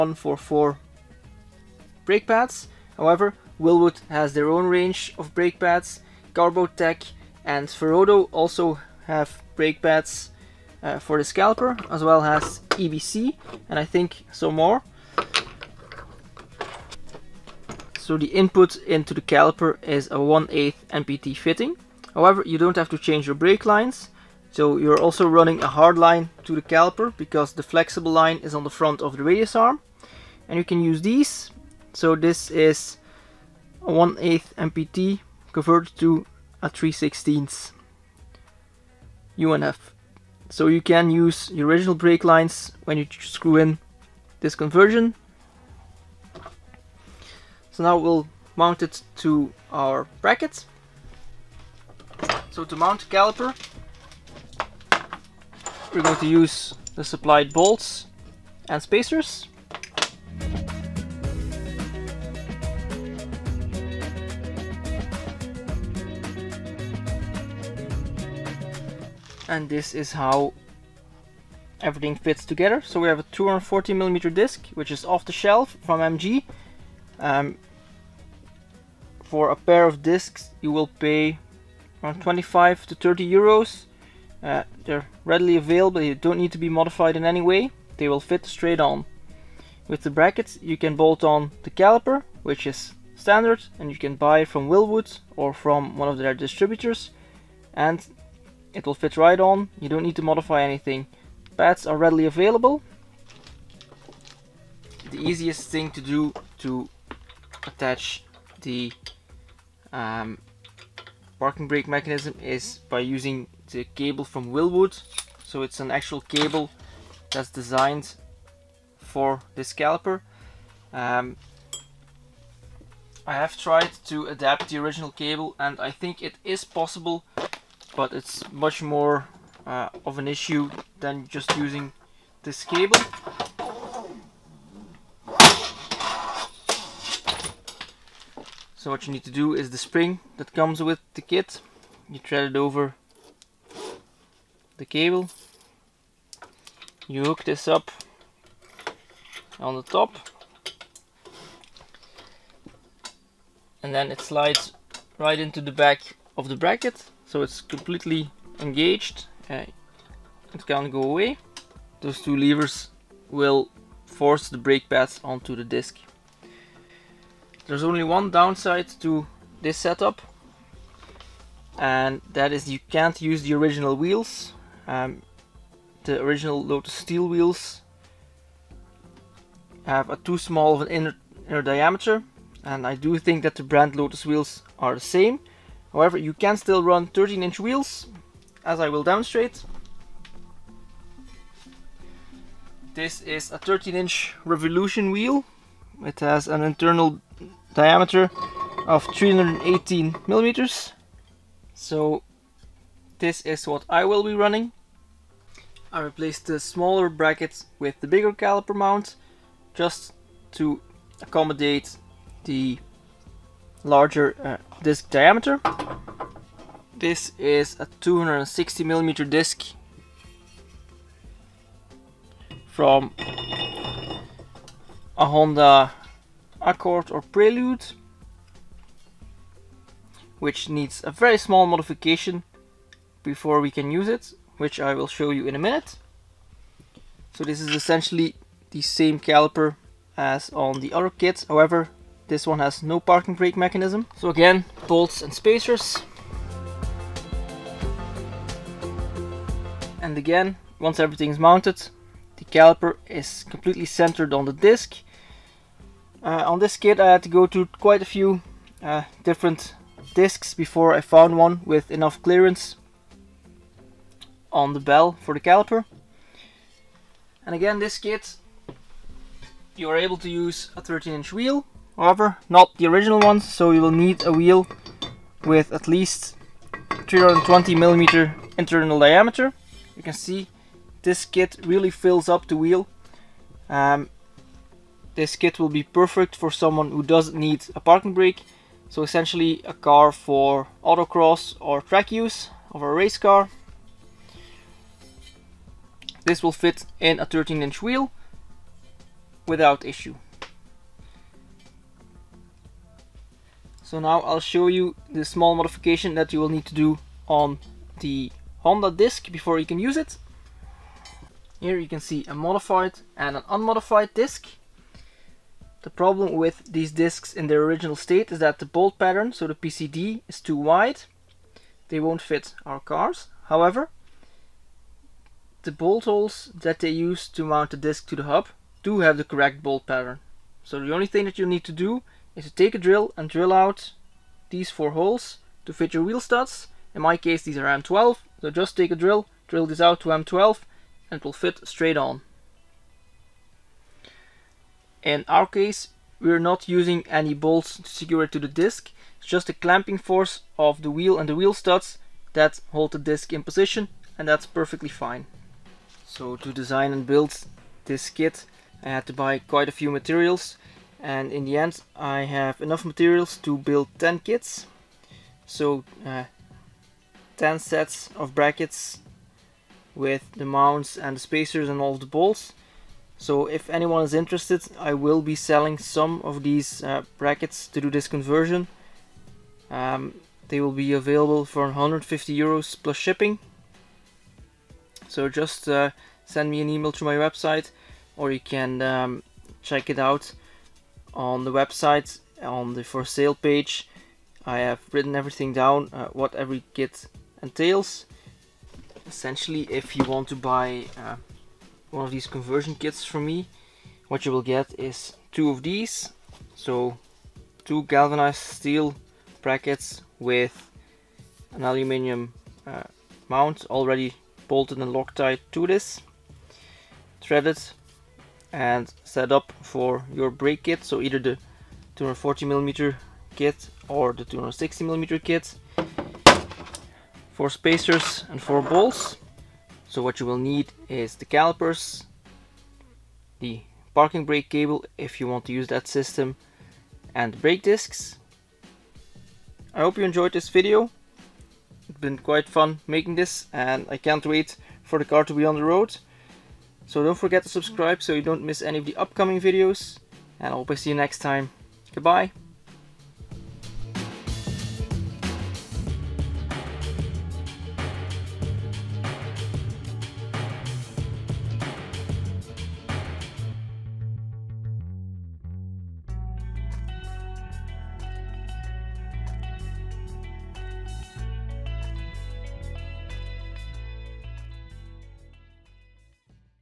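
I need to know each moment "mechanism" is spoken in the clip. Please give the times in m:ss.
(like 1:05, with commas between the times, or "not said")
1:51, 4:03.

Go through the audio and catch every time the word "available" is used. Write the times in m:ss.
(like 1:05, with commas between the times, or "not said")
1:25, 1:42, 6:20.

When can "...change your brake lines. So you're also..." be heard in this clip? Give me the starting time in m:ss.
0:22.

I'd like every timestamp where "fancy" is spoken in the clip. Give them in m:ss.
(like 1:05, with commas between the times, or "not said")
not said.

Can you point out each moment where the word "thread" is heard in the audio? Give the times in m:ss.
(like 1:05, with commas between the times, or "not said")
2:22, 6:57.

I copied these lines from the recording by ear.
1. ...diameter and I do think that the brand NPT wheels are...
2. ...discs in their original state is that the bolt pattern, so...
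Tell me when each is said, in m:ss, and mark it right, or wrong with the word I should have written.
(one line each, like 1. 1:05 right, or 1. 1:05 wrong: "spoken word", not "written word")
1. 3:01 wrong: "Lotus", not "NPT"
2. 5:16 right.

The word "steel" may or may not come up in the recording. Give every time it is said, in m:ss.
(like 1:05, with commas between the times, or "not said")
2:56, 6:48.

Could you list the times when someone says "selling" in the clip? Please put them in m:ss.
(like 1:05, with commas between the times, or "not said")
6:15.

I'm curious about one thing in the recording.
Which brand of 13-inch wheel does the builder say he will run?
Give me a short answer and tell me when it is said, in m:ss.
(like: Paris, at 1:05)
Revolution, at 3:14.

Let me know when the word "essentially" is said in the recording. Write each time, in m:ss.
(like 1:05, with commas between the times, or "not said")
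3:57, 4:49, 6:39.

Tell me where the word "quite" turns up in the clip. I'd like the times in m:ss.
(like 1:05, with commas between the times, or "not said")
4:17, 5:59, 7:22.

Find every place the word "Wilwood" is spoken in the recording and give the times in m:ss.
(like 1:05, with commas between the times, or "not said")
0:03, 1:34, 1:54.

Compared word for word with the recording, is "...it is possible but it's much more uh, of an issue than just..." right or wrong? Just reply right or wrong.
right.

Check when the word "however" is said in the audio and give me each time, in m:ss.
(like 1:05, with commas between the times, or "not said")
0:02, 0:22, 3:05, 4:01, 4:31, 5:23.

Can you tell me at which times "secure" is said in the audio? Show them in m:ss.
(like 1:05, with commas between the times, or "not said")
5:47.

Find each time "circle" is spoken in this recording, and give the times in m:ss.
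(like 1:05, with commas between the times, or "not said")
not said.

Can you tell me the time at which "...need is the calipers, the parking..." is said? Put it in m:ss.
7:10.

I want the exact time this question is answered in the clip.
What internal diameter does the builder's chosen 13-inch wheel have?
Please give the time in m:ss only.
3:19.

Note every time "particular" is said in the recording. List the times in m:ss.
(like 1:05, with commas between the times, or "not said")
not said.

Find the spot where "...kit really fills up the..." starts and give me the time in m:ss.
4:41.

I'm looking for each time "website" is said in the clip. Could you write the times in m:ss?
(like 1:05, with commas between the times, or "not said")
6:27, 6:31.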